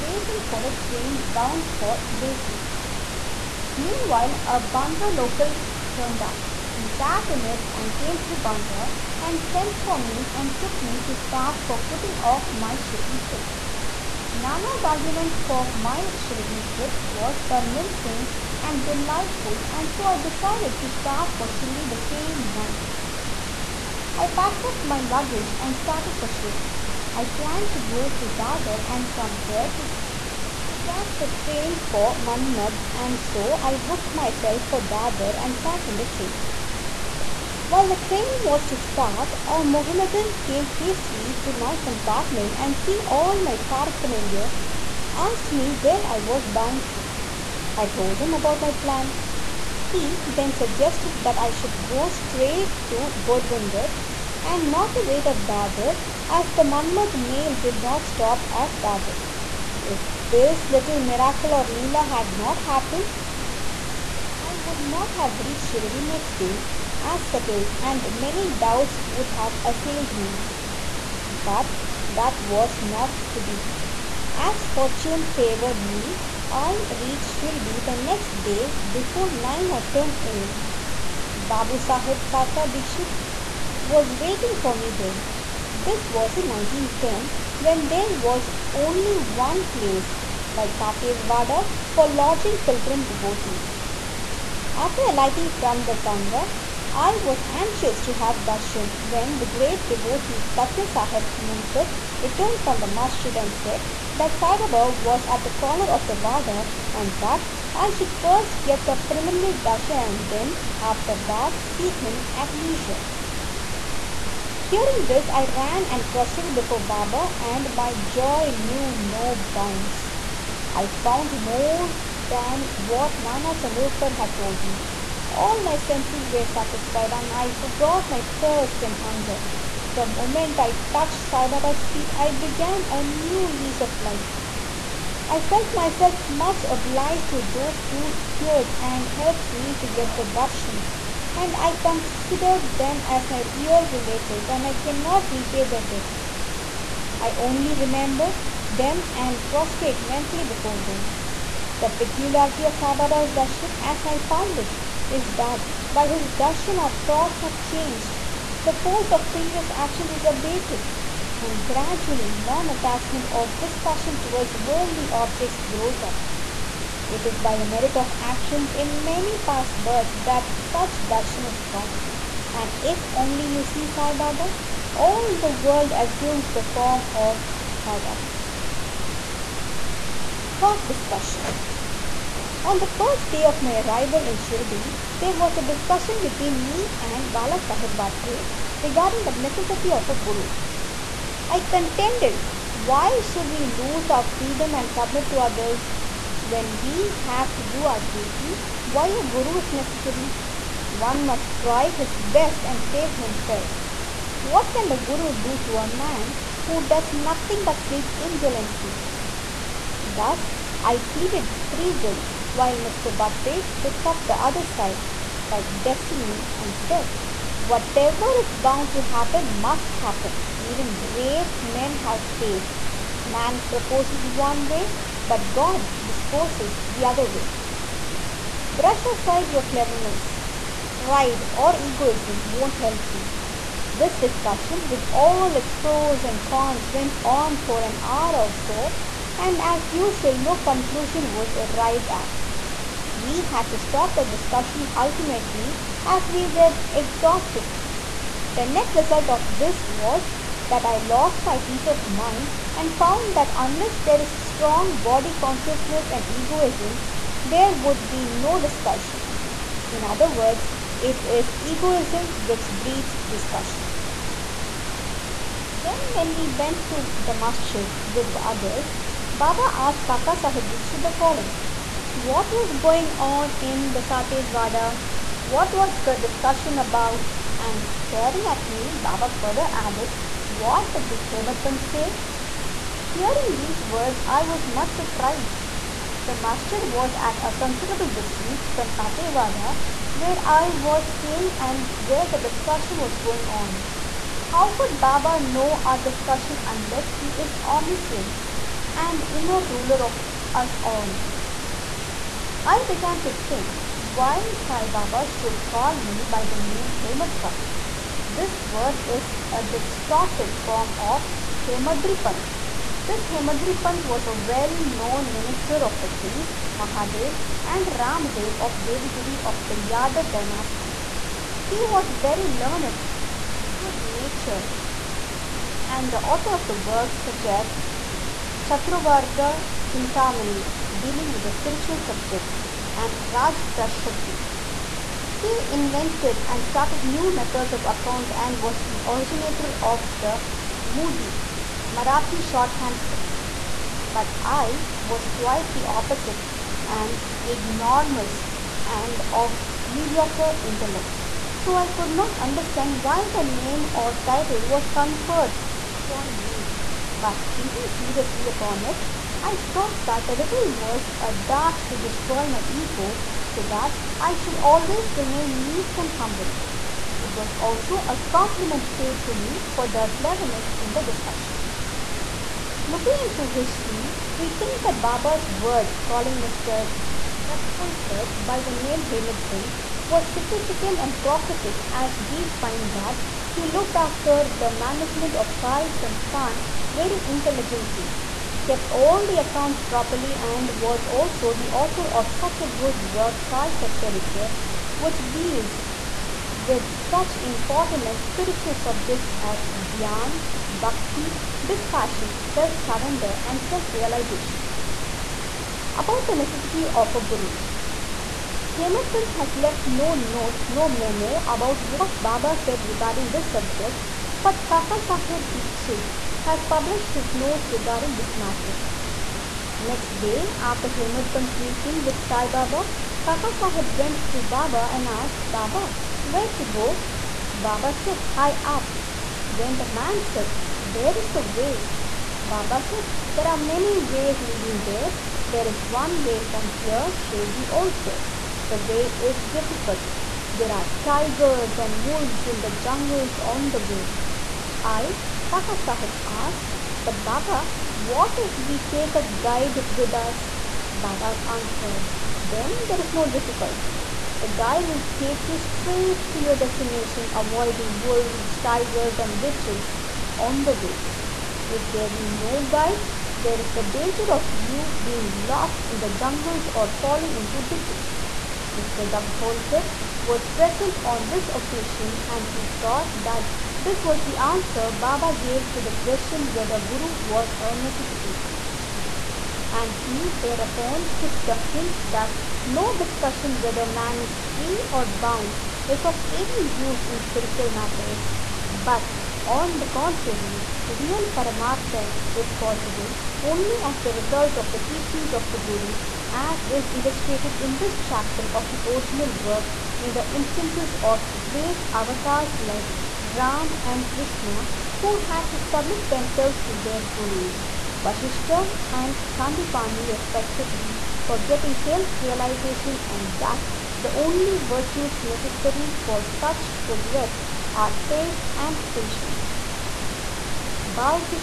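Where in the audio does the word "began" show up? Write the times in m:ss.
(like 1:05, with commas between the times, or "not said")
2:12, 5:02.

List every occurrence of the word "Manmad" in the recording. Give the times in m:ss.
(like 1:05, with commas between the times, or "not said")
0:32, 0:56.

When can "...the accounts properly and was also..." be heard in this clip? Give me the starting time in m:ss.
6:29.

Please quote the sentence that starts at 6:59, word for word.
Next day, after Hemadpant's meeting with Sai Baba, Kaka Sahib went to Baba and asked Baba where to go.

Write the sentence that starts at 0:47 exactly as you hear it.
I told him about my plan.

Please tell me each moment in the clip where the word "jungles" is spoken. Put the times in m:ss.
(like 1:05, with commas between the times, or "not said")
7:22, 7:46.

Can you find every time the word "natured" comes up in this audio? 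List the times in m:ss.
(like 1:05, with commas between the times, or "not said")
5:24.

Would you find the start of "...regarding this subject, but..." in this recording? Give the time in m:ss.
6:52.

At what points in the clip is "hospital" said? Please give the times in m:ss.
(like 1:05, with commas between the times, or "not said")
not said.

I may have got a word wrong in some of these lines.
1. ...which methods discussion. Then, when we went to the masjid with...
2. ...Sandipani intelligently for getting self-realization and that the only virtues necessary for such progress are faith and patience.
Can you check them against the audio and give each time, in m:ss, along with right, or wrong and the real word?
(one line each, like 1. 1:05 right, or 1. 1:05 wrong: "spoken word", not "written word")
1. 4:22 wrong: "breeds", not "methods"
2. 8:29 wrong: "respectively", not "intelligently".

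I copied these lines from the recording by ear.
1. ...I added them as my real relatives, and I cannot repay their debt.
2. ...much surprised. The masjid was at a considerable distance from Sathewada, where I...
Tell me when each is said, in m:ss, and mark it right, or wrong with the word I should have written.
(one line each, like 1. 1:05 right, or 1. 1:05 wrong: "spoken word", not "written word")
1. 2:21 wrong: "considered", not "added"
2. 4:44 right.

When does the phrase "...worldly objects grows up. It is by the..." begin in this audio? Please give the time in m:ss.
2:44.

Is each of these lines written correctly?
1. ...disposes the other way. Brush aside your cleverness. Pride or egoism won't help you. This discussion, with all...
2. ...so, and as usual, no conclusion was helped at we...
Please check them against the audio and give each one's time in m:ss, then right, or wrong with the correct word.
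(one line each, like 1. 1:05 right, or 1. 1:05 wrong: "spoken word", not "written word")
1. 3:46 right
2. 3:58 wrong: "arrived", not "helped".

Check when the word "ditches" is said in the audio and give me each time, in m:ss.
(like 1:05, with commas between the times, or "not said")
7:39, 7:47.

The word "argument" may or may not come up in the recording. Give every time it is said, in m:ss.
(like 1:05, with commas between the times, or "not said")
0:14.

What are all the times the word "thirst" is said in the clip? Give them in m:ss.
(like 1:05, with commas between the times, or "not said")
2:08.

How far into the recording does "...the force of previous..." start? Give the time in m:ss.
2:38.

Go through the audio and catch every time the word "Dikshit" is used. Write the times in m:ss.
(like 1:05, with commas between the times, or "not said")
1:22, 4:30, 6:55.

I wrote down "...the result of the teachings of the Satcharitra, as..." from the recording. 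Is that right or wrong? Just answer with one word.
wrong.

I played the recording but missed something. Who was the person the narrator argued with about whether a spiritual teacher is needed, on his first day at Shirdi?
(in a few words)
Bala Sahib Bhatte.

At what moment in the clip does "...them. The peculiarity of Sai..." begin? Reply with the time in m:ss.
2:30.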